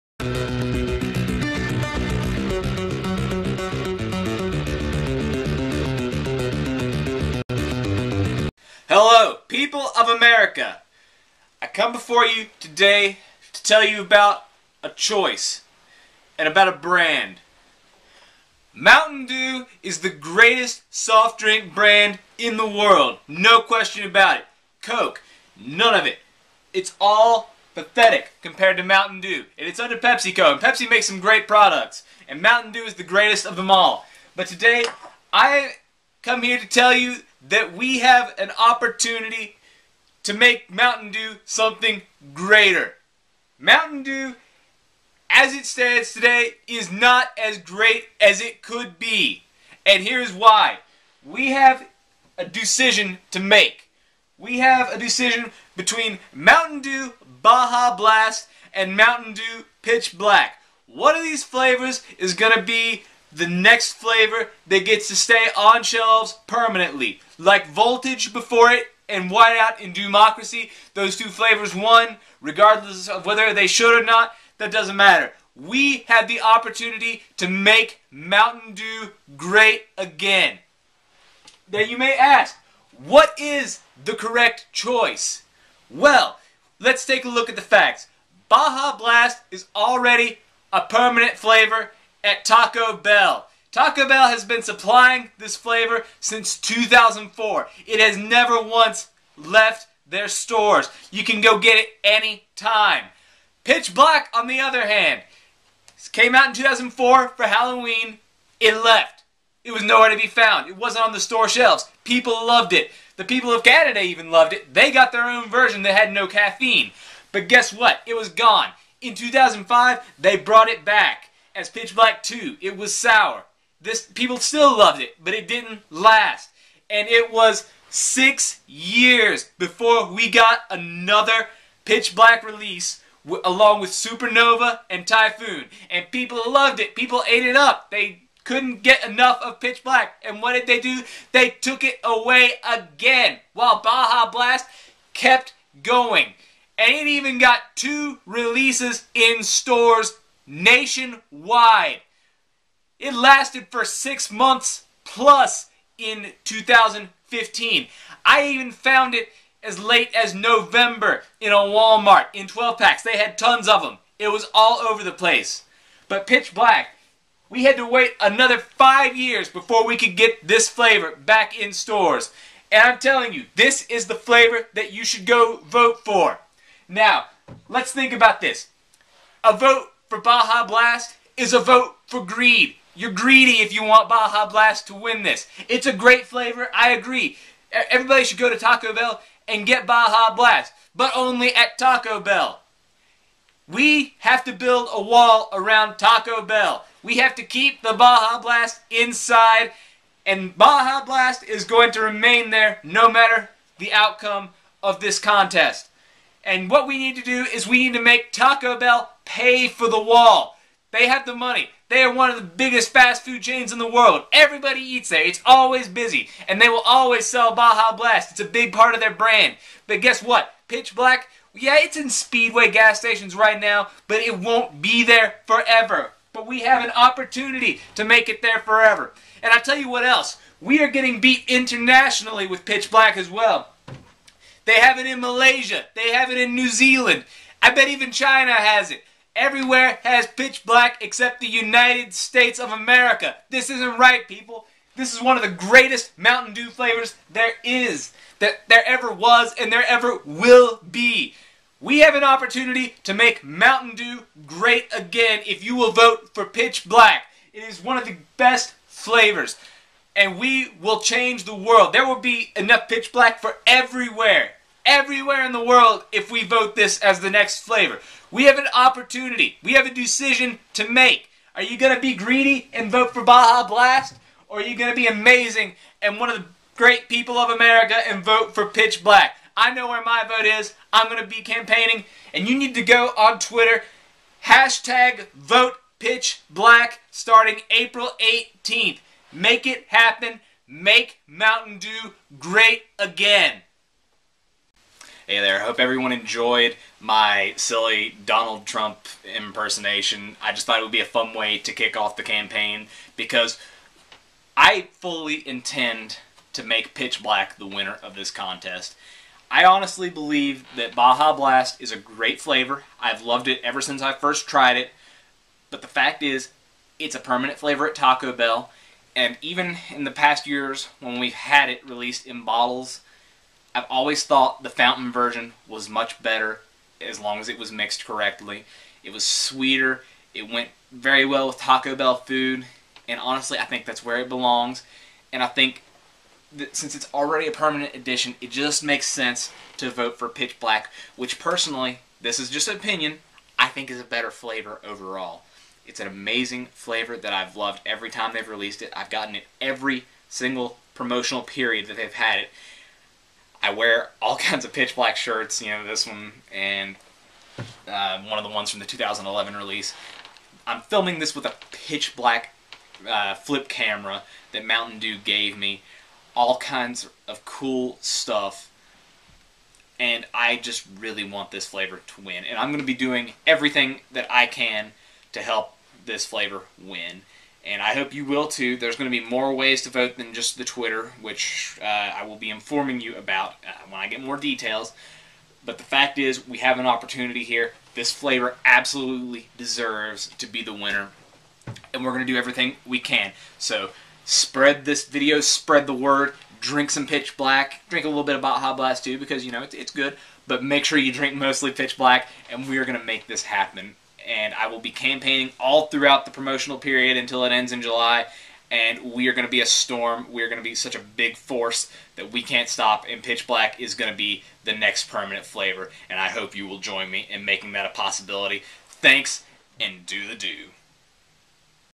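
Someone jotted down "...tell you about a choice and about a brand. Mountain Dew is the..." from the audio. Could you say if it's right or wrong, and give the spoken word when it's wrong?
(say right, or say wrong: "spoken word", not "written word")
right.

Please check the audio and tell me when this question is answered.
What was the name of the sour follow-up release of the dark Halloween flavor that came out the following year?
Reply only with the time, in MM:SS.
02:01.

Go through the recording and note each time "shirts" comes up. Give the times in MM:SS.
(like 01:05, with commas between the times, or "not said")
05:55.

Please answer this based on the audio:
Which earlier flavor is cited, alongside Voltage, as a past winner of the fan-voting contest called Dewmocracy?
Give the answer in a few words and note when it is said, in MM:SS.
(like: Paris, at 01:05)
Whiteout, at 01:09.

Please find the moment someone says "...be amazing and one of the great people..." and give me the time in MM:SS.
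04:34.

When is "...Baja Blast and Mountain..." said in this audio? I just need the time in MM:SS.
00:57.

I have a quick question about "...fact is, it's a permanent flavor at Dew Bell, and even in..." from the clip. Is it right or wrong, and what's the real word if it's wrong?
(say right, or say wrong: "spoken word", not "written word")
wrong: "Taco", not "Dew".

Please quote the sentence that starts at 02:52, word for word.
And I'm telling you, this is the flavor that you should go vote for.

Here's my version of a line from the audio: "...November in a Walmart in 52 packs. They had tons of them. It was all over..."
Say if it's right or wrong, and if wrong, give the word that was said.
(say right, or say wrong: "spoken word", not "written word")
wrong: "12", not "52".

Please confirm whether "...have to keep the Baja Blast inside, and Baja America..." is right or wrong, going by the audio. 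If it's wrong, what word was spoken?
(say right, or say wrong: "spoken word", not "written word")
wrong: "Blast", not "America".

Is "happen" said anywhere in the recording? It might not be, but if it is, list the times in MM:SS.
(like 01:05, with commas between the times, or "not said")
04:49, 06:43.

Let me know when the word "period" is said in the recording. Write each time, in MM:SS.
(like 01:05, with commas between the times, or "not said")
05:51, 06:46.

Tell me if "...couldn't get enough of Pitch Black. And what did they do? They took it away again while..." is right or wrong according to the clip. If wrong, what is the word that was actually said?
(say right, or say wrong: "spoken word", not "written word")
right.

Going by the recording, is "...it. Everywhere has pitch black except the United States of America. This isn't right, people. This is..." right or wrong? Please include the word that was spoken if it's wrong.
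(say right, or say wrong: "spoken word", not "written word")
right.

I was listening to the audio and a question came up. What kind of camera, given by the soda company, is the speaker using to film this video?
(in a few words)
Flip camera.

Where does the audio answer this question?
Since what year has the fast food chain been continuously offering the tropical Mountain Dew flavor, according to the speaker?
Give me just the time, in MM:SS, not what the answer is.
01:36.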